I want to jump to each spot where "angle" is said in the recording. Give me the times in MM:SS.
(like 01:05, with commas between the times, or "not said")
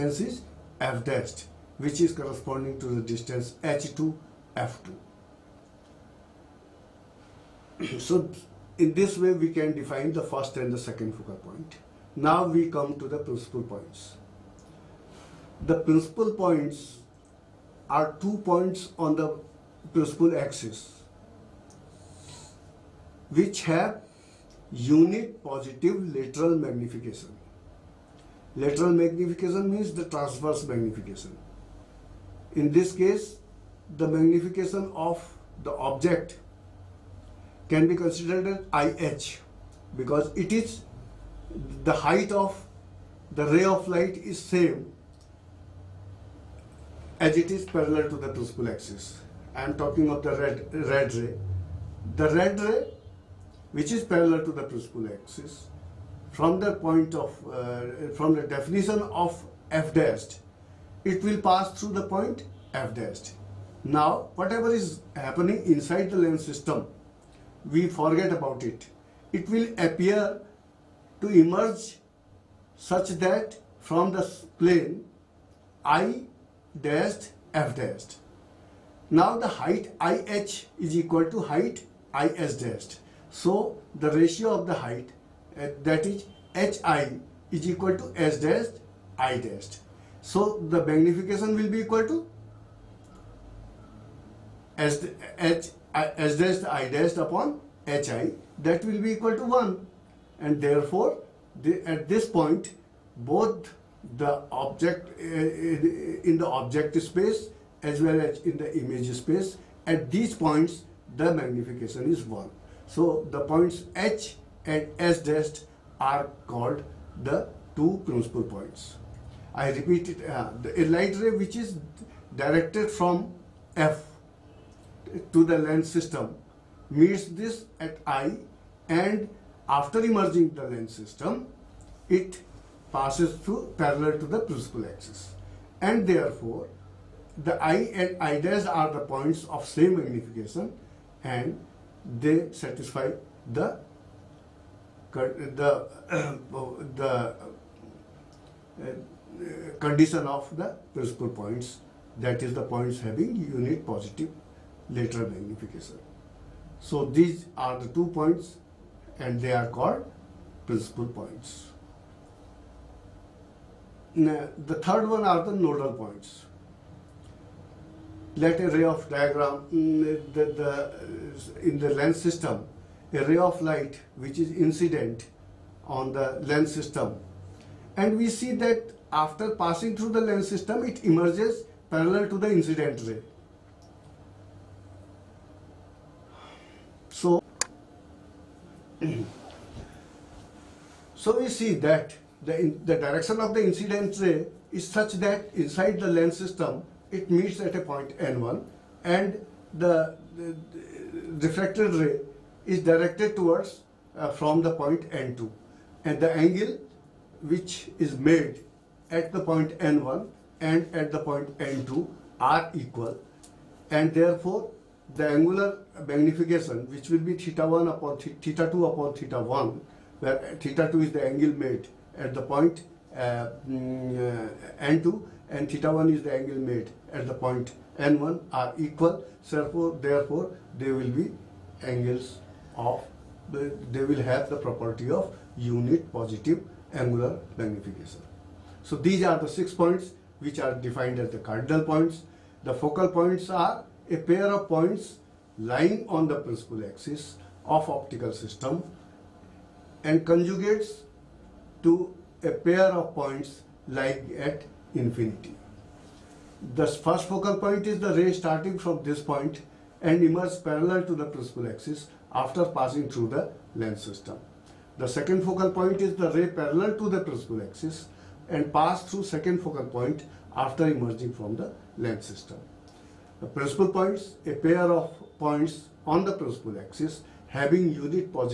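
03:26, 03:41, 03:46, 03:51.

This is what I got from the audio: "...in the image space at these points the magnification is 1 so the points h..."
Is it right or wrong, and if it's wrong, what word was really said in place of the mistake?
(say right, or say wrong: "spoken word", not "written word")
right.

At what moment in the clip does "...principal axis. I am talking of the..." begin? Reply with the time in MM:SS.
00:48.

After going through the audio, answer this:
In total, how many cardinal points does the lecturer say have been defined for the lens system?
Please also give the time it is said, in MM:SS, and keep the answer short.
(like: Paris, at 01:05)
6, at 03:59.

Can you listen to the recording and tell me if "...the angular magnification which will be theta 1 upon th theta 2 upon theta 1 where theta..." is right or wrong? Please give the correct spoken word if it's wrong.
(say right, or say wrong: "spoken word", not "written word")
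right.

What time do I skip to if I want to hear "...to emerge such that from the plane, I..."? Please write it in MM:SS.
01:11.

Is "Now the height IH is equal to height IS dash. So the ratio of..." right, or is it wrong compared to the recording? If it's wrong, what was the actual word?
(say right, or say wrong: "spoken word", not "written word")
right.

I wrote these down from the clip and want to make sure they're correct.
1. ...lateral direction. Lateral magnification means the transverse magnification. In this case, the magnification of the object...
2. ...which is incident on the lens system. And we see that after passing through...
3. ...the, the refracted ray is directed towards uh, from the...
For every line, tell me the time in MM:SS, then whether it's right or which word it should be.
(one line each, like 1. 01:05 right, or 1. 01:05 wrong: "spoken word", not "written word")
1. 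00:26 wrong: "magnification", not "direction"
2. 02:54 right
3. 03:20 right.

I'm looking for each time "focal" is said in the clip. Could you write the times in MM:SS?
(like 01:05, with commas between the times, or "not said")
00:11, 04:02, 04:17, 04:25, 04:29.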